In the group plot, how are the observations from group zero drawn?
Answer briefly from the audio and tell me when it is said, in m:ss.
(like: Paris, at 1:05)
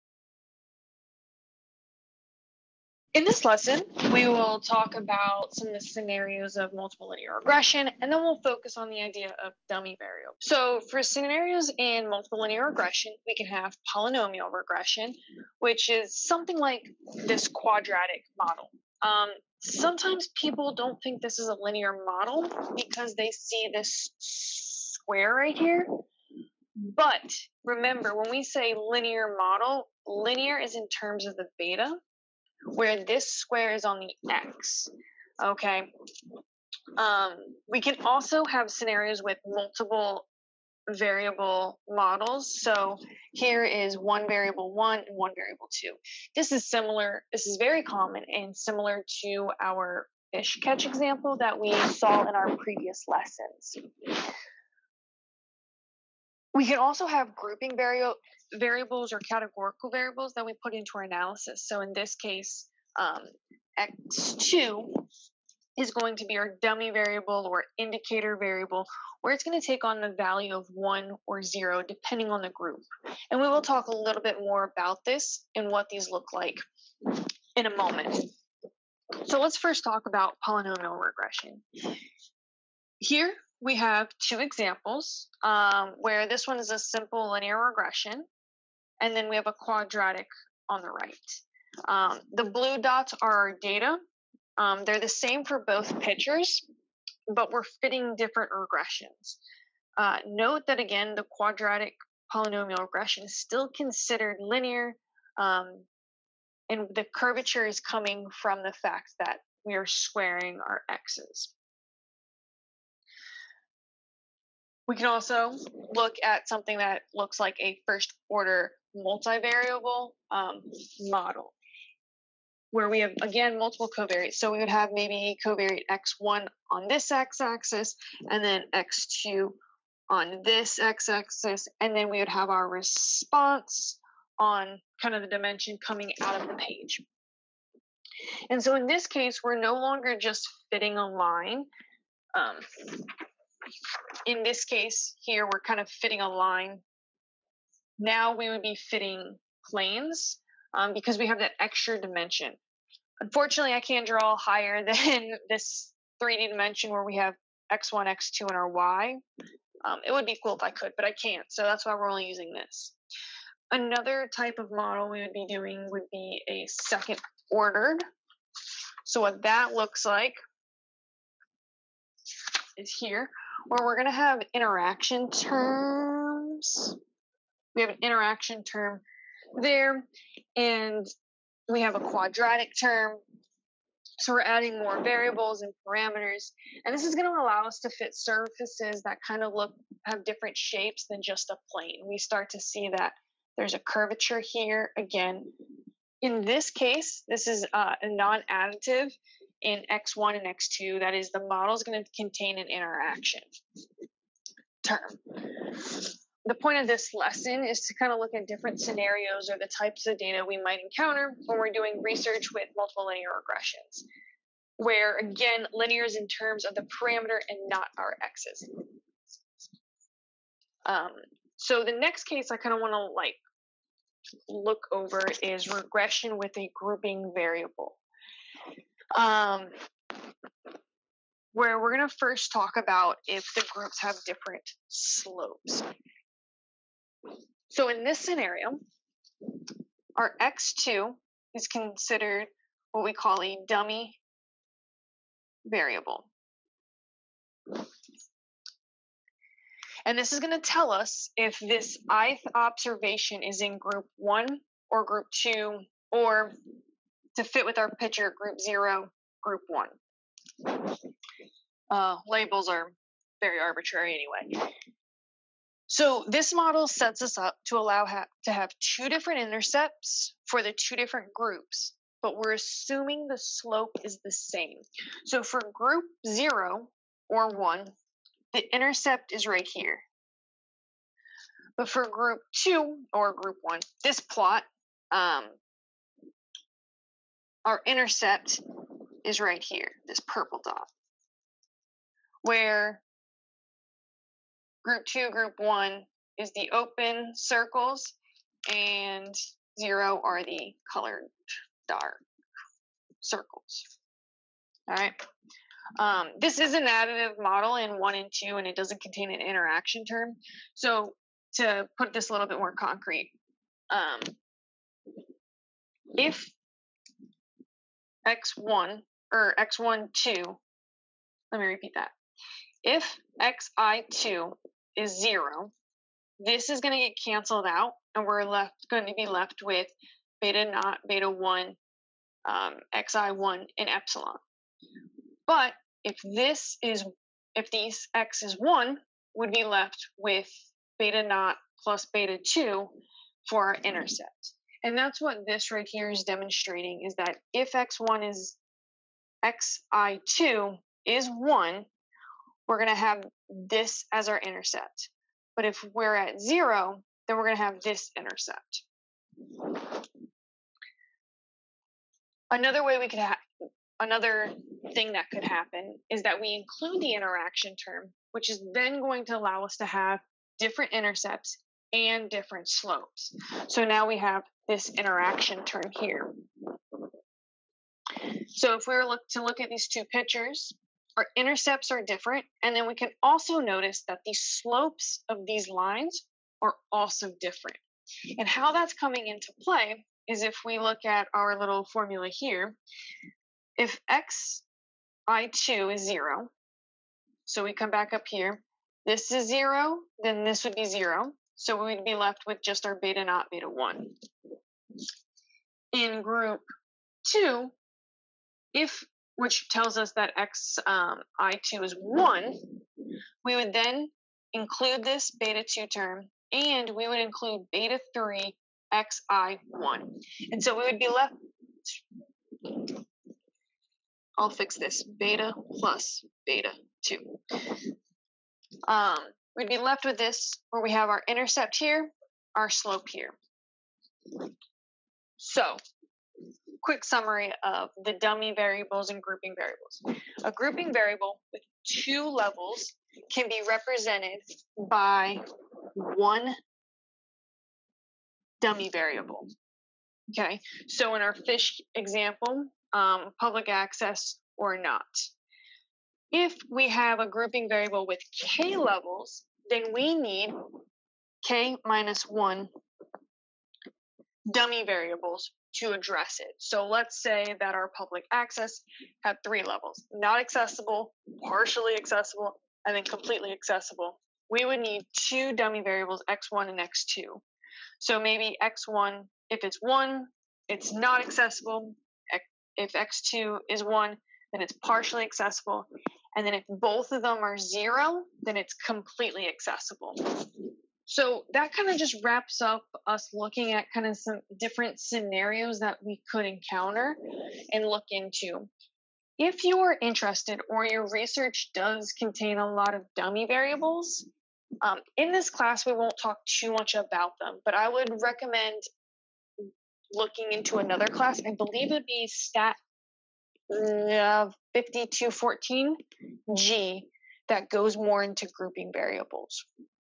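colored dark circles, at 5:00.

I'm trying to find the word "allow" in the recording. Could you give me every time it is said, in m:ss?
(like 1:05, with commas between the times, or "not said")
3:07, 4:27, 6:09.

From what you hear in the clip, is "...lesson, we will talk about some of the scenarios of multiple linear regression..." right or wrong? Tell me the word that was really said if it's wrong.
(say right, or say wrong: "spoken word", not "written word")
right.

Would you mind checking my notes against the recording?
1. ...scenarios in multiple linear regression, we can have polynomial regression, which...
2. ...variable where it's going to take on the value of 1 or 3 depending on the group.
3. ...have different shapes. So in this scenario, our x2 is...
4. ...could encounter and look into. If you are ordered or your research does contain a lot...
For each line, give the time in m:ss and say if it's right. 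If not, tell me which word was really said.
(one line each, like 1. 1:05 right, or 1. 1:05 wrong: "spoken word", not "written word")
1. 0:11 right
2. 1:08 wrong: "0", not "3"
3. 3:54 wrong: "slopes", not "shapes"
4. 8:16 wrong: "interested", not "ordered".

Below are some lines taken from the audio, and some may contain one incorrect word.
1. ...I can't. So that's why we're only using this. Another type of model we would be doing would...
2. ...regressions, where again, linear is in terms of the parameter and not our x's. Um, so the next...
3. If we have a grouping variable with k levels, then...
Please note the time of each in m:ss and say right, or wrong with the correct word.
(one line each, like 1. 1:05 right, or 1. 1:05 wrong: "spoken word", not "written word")
1. 2:41 right
2. 3:33 right
3. 7:36 right.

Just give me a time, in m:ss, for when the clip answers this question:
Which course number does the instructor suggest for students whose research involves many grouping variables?
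8:34.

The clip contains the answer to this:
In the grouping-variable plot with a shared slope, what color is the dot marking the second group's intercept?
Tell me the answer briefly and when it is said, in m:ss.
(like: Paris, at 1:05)
purple, at 4:50.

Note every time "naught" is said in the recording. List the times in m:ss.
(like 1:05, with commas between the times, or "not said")
5:30, 5:41, 6:43.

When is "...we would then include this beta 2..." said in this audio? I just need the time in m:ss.
6:53.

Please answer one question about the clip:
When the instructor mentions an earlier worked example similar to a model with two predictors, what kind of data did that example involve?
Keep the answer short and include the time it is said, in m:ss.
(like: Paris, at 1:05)
fish catch, at 0:50.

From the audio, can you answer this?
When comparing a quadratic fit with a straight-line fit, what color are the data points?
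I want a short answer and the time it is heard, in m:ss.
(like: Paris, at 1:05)
blue, at 1:32.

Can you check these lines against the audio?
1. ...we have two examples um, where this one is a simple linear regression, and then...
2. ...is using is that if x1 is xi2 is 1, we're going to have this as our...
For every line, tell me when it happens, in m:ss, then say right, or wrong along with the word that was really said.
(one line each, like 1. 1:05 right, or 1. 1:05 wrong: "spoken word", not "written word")
1. 1:23 right
2. 5:46 wrong: "demonstrating", not "using".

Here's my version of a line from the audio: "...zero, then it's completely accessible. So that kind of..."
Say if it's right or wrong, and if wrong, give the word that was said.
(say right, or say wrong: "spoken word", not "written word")
right.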